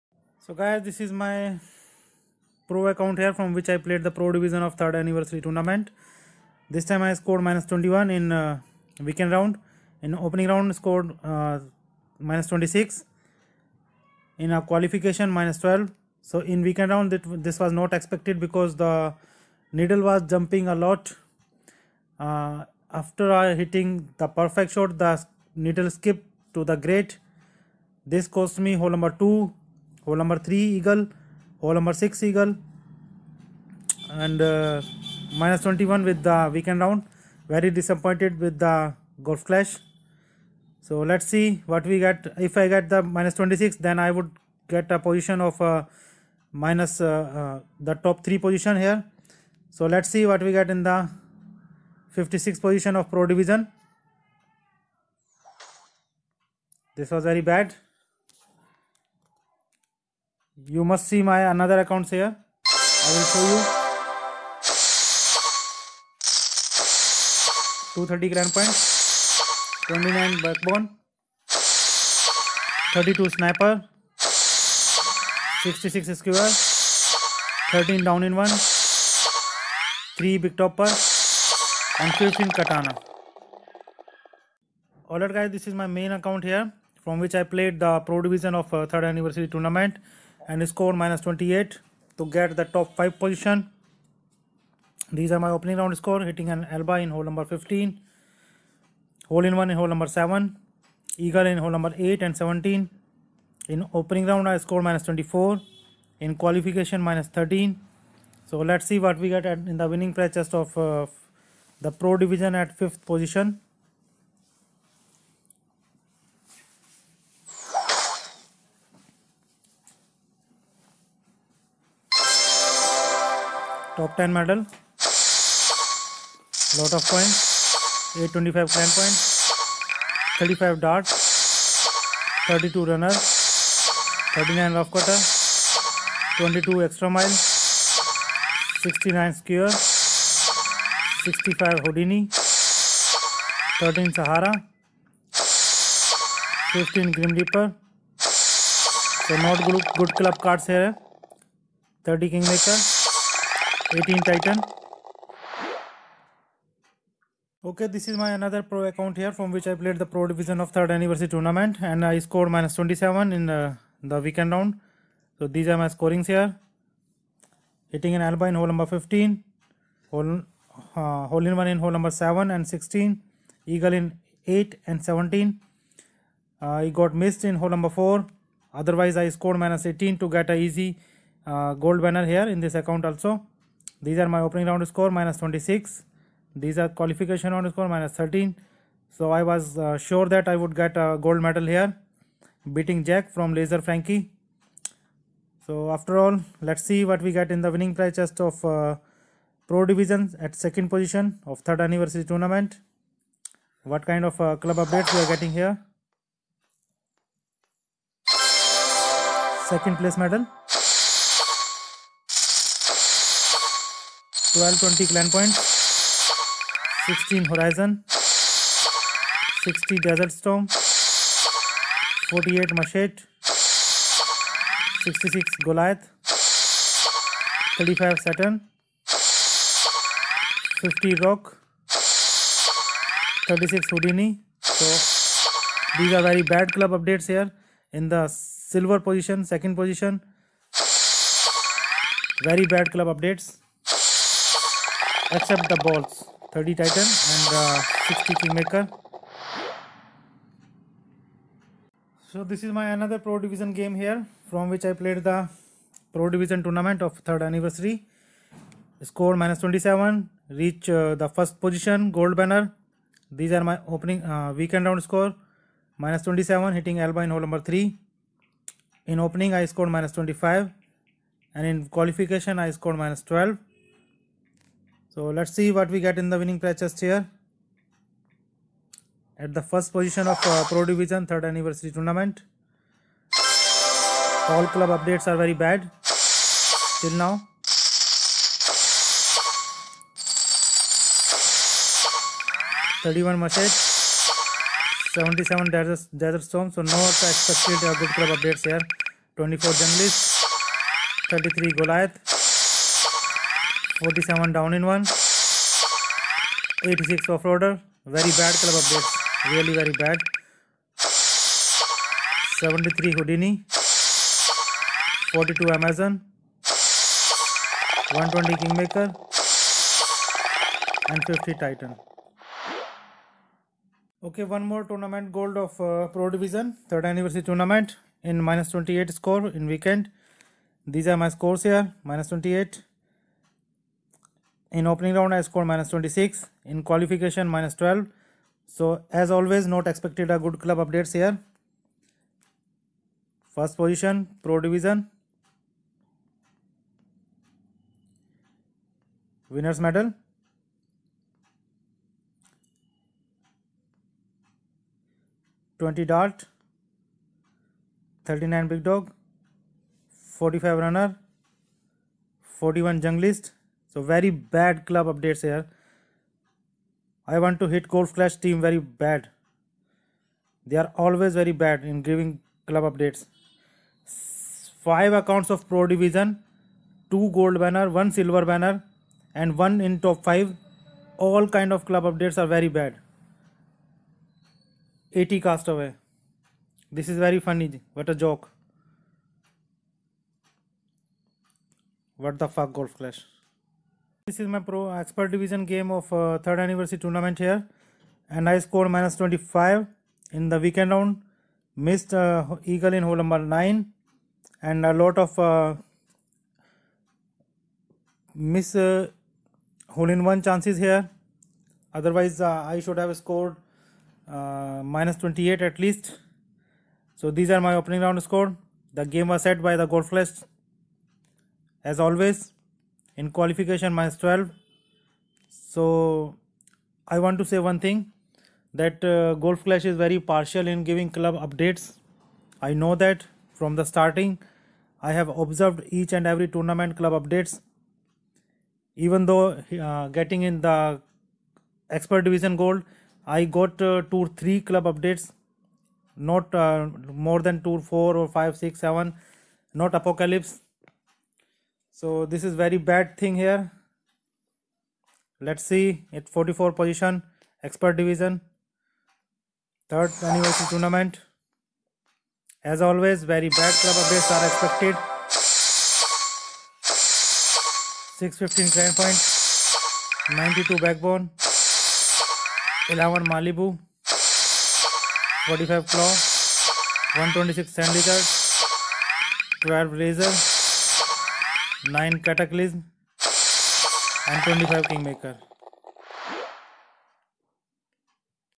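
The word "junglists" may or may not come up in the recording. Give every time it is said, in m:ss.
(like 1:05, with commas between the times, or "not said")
4:59, 6:03.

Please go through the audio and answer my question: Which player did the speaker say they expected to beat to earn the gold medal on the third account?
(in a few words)
Jack.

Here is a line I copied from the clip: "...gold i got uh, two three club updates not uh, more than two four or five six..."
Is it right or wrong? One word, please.
right.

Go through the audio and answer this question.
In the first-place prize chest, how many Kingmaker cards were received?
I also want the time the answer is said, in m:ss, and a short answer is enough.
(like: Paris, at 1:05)
120, at 5:18.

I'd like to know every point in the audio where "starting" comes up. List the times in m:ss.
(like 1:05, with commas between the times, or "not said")
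7:13.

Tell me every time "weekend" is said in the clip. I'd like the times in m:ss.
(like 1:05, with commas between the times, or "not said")
0:08, 0:16, 0:36, 2:44, 4:24, 5:29, 6:40.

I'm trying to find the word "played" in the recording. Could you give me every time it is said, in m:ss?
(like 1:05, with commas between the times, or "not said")
0:03, 1:27, 2:39, 4:15.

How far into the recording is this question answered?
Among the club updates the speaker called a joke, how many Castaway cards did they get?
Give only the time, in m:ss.
6:25.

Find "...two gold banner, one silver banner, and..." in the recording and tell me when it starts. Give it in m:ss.
6:17.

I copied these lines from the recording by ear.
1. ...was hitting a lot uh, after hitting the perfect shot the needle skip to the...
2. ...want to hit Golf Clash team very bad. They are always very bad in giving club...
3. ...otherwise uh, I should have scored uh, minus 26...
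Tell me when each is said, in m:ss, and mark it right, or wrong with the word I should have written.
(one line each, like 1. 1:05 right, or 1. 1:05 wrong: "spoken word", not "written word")
1. 0:20 wrong: "jumping", not "hitting"
2. 6:07 right
3. 6:51 wrong: "28", not "26".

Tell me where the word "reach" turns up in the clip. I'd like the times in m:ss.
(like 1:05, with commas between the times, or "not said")
4:20.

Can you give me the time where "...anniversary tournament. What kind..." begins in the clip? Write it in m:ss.
3:21.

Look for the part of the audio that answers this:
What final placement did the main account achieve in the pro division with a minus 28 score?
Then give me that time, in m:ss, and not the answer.
1:52.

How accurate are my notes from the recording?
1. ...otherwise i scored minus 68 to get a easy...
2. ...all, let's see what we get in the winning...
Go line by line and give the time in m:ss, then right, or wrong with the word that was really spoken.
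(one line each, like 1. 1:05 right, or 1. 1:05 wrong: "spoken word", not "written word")
1. 2:58 wrong: "18", not "68"
2. 3:16 right.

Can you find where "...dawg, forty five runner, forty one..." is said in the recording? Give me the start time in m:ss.
5:58.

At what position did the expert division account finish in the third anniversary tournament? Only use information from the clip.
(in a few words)
44.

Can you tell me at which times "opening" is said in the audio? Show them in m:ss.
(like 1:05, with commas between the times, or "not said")
0:10, 1:35, 1:43, 3:04, 4:23, 4:29, 5:34, 6:57.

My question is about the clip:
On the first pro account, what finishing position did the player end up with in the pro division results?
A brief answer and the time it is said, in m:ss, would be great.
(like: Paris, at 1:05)
56, at 0:52.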